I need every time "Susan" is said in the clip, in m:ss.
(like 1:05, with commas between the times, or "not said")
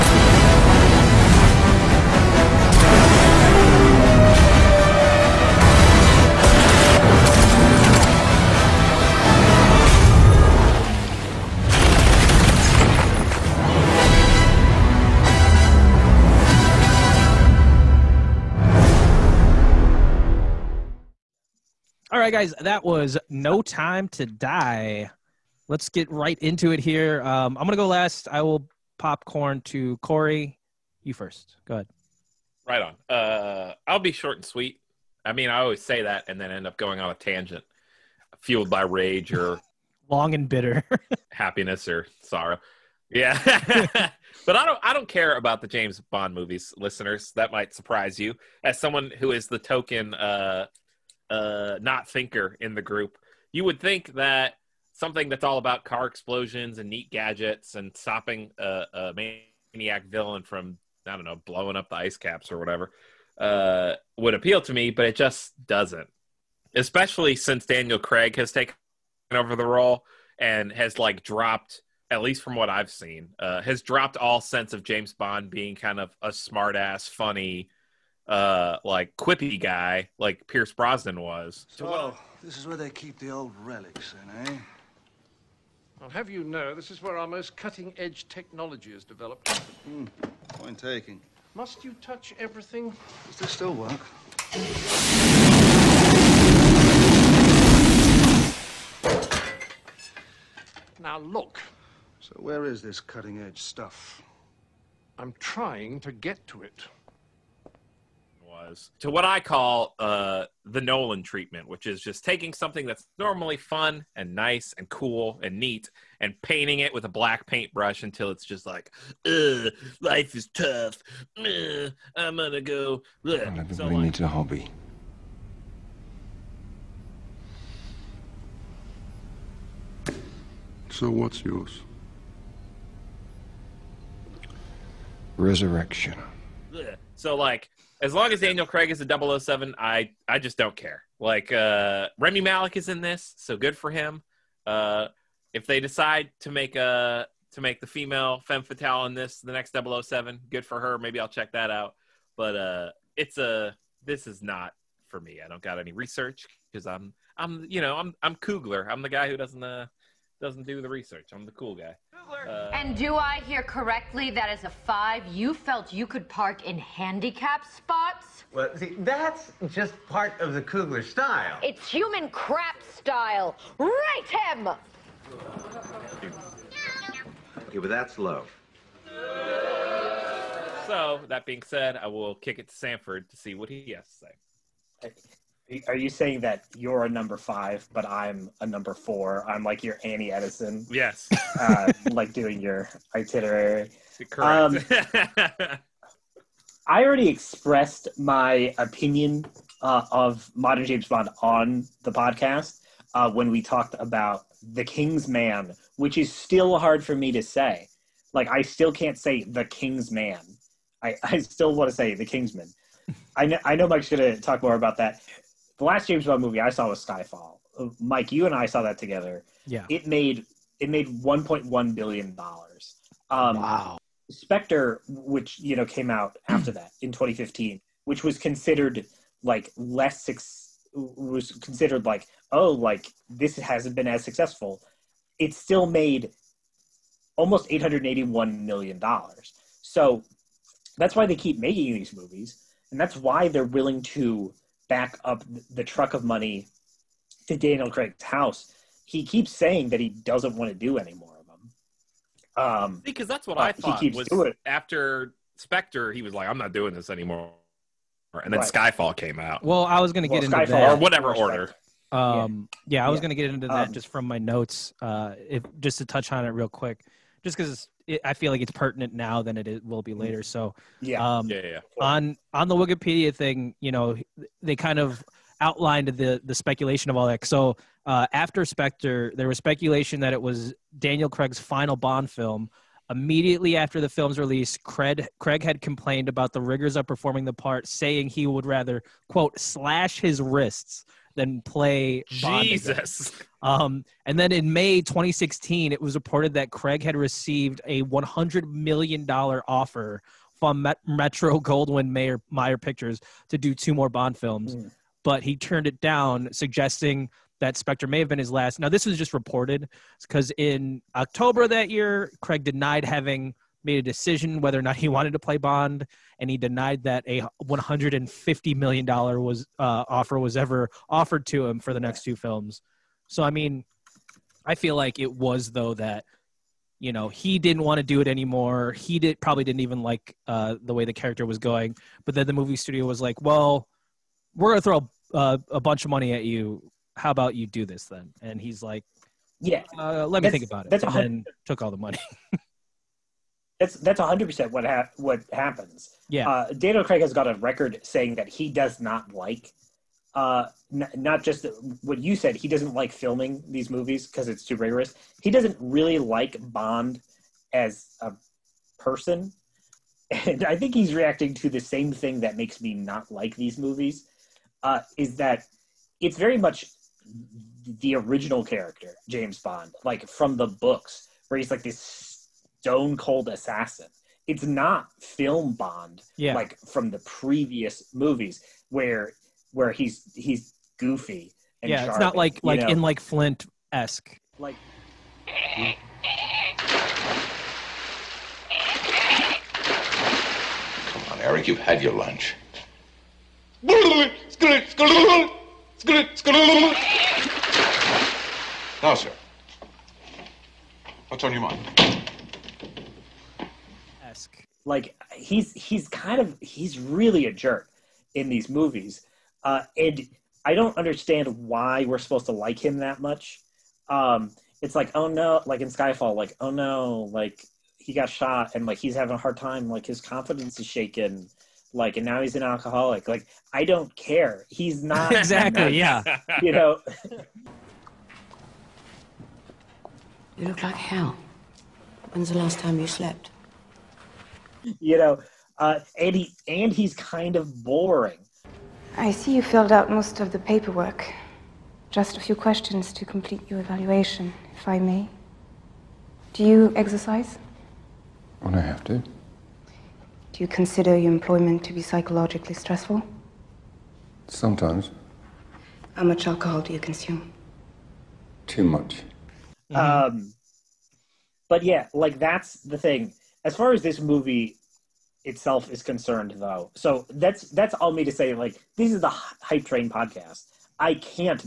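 not said.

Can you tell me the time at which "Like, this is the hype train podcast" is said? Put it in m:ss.
7:48.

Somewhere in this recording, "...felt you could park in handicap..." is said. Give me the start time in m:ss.
2:45.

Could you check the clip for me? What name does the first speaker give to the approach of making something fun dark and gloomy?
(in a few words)
the Nolan treatment.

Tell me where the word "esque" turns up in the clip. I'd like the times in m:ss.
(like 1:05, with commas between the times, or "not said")
6:23, 6:44.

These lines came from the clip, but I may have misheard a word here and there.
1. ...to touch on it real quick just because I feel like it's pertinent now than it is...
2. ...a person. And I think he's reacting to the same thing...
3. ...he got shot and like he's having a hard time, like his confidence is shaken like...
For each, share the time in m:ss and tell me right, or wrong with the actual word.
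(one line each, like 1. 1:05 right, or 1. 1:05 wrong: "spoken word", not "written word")
1. 4:25 right
2. 5:58 right
3. 6:57 right.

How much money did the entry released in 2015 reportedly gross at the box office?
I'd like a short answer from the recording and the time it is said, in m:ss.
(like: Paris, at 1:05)
881 million dollars, at 3:57.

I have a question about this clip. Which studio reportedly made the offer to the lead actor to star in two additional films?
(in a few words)
Metro Goldwyn Mayer.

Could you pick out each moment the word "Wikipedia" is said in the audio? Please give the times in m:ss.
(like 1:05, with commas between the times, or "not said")
4:32.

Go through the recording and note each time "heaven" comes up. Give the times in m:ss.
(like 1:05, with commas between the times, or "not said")
not said.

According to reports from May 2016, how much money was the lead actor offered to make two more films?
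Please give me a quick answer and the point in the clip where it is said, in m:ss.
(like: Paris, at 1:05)
100 million dollars, at 4:58.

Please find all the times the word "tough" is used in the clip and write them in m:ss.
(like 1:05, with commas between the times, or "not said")
2:00.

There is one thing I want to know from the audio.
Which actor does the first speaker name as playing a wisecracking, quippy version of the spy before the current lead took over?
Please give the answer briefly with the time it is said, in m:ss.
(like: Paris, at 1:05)
Pierce Brosnan, at 1:20.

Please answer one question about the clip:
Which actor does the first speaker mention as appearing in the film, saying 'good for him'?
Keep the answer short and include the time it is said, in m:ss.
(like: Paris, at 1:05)
Rami Malek, at 2:22.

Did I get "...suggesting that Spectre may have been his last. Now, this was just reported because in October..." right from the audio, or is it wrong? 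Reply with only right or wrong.
right.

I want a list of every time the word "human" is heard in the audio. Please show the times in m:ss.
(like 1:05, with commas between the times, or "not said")
2:51.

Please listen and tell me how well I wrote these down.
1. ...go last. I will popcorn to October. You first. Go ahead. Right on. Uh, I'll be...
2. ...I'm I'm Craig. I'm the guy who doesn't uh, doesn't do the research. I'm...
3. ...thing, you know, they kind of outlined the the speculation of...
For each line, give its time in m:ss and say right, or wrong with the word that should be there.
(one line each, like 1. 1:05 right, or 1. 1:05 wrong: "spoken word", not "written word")
1. 0:27 wrong: "Corey", not "October"
2. 2:37 wrong: "Kugler", not "Craig"
3. 4:33 right.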